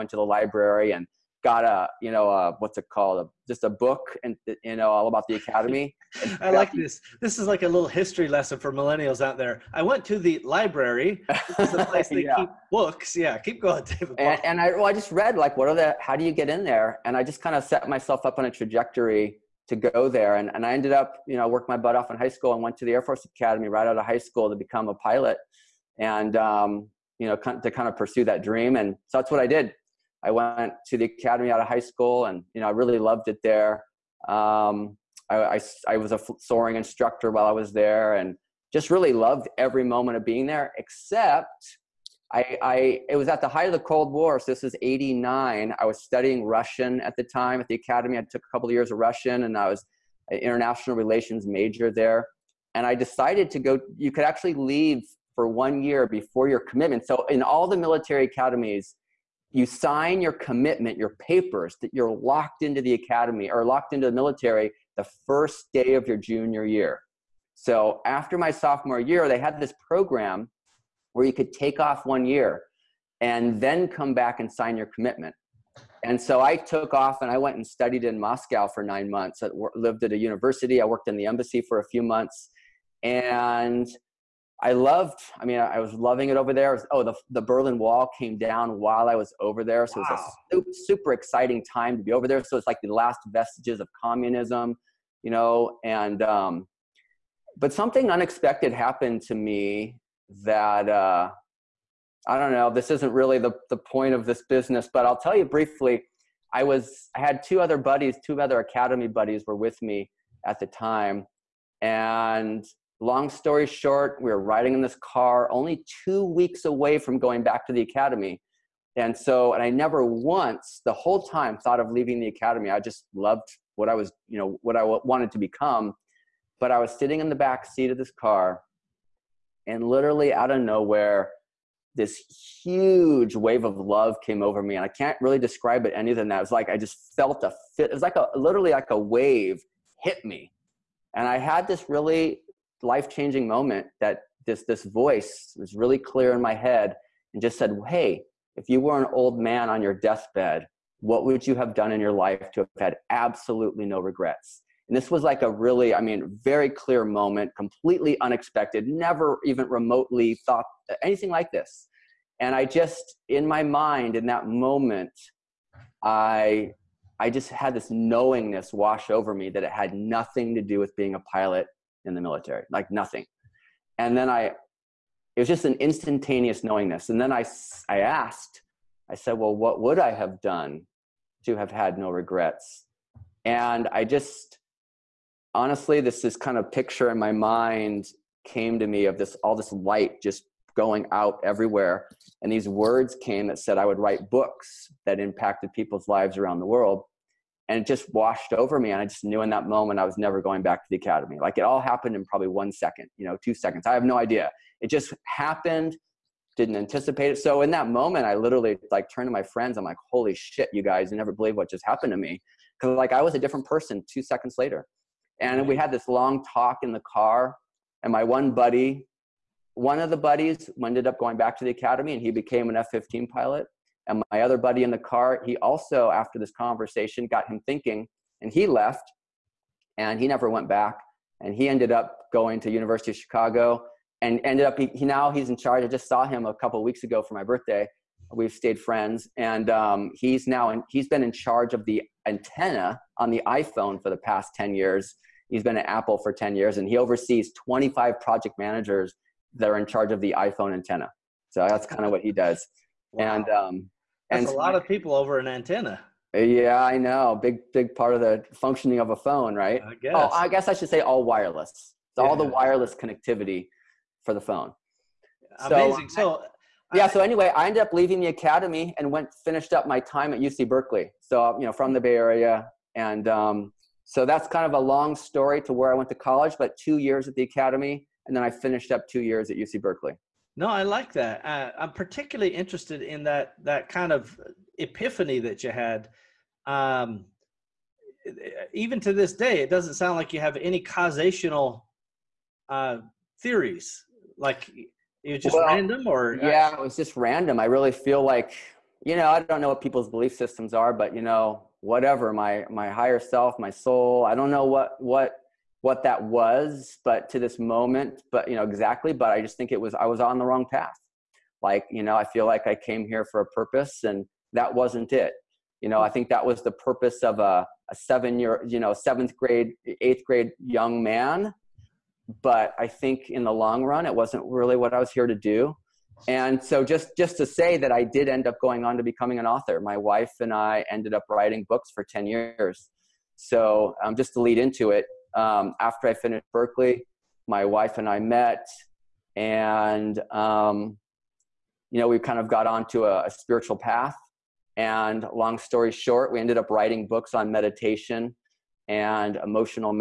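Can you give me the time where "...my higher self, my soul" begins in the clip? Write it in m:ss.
5:02.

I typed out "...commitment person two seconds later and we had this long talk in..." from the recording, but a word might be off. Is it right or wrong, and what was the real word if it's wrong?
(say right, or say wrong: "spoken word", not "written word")
wrong: "different", not "commitment".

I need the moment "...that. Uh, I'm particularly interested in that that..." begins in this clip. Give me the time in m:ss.
4:41.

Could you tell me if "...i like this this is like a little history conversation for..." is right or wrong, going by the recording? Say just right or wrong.
wrong.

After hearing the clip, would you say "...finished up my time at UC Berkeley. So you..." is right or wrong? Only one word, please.
right.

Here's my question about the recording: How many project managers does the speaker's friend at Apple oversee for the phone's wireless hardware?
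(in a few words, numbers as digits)
25.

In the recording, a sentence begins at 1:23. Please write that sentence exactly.
And I loved, I mean, I was loving it over there.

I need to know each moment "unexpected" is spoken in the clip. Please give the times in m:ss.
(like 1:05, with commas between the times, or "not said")
1:38, 2:38.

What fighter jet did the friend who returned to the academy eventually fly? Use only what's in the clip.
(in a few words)
F-15.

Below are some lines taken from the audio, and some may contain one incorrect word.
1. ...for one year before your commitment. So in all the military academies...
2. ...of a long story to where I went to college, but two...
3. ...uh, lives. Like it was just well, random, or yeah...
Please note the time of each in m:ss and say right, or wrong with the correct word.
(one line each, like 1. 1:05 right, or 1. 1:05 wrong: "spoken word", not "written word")
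1. 0:55 right
2. 4:34 right
3. 4:52 wrong: "theories", not "lives".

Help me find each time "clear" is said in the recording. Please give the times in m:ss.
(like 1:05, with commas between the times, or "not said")
2:25, 2:36.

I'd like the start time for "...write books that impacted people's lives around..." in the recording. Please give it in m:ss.
3:13.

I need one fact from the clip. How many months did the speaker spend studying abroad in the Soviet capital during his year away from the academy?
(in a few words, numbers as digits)
9.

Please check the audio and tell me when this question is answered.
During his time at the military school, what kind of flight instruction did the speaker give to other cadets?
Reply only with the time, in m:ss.
0:36.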